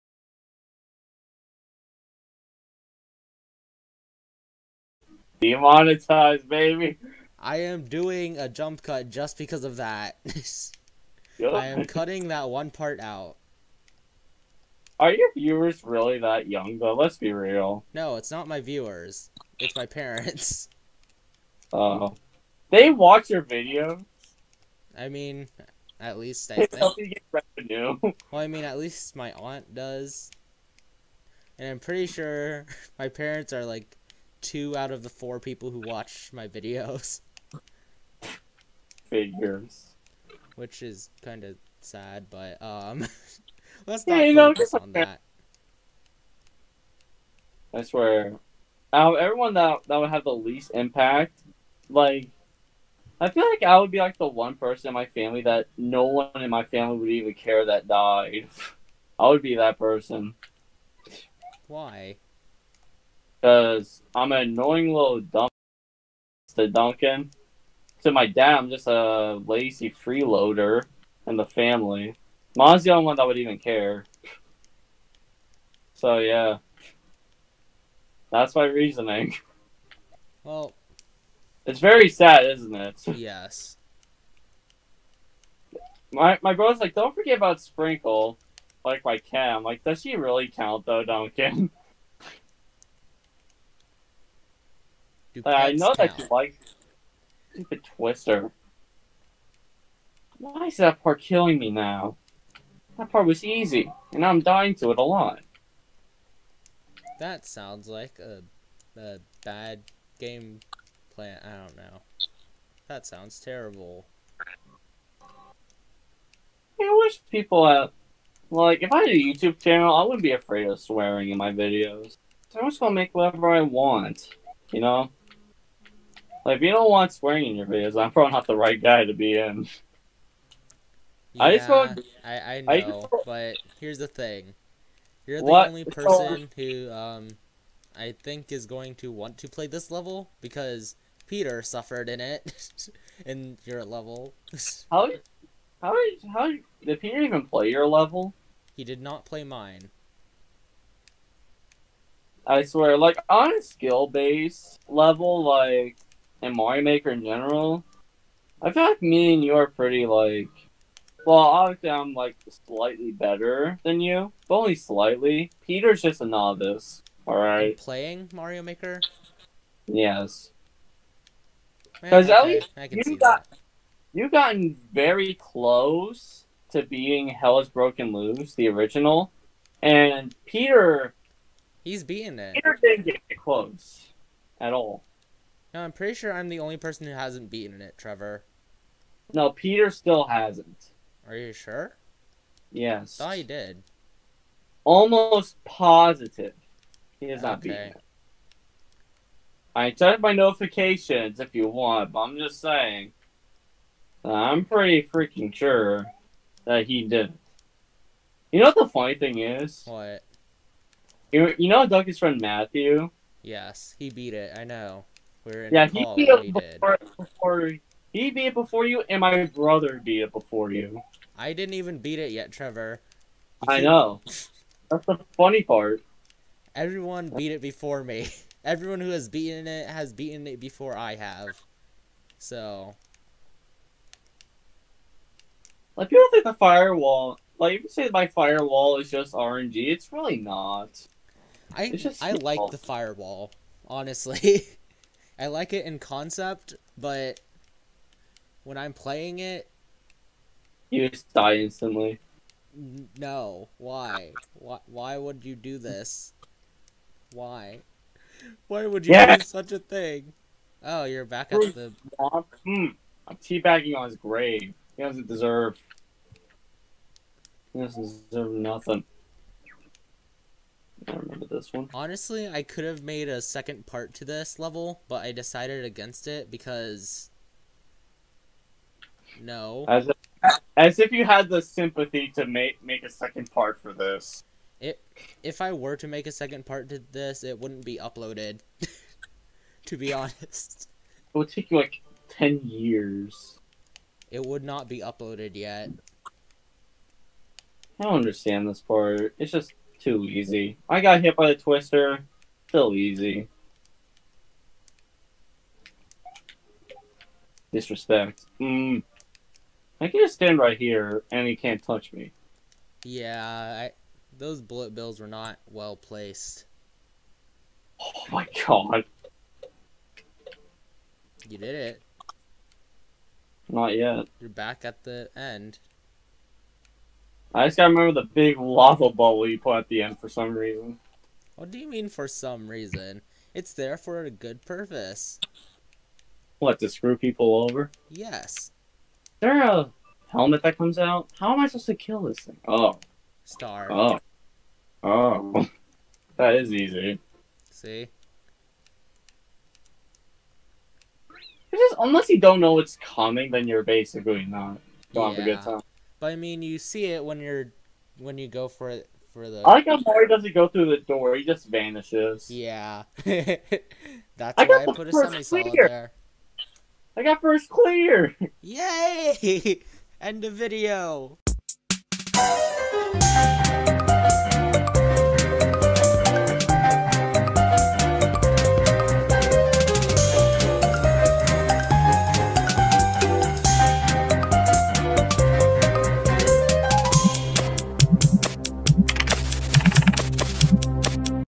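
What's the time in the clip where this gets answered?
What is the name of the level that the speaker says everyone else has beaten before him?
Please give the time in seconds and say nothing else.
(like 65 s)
177 s.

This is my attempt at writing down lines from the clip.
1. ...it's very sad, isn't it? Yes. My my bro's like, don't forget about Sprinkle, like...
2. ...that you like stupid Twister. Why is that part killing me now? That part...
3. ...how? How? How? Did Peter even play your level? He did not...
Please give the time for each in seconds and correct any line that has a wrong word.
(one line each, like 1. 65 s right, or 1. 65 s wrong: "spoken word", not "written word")
1. 81 s right
2. 95 s right
3. 144 s right.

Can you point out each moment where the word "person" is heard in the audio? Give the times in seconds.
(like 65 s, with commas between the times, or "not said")
54 s, 59 s, 135 s, 186 s.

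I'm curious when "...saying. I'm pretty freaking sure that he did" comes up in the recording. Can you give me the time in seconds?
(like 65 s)
202 s.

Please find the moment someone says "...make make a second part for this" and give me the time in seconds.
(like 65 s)
282 s.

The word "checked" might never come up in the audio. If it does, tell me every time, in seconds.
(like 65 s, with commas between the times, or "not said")
199 s.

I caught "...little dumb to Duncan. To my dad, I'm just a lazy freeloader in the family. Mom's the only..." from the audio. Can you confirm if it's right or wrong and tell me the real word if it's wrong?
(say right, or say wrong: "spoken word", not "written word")
right.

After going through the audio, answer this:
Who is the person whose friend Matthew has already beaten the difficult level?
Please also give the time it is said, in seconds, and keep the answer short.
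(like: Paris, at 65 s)
Dougie, at 211 s.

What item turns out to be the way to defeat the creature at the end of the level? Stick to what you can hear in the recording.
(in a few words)
Star.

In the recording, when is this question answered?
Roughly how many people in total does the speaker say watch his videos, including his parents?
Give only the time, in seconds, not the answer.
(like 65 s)
35 s.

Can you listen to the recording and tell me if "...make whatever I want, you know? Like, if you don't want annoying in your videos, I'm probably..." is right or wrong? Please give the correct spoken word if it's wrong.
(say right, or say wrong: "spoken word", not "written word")
wrong: "swearing", not "annoying".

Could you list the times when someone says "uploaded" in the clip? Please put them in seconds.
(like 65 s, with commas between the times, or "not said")
288 s, 295 s.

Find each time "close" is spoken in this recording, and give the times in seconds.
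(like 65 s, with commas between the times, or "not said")
175 s, 183 s.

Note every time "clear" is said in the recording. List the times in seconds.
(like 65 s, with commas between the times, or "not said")
367 s.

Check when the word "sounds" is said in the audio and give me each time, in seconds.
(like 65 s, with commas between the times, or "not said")
107 s, 113 s.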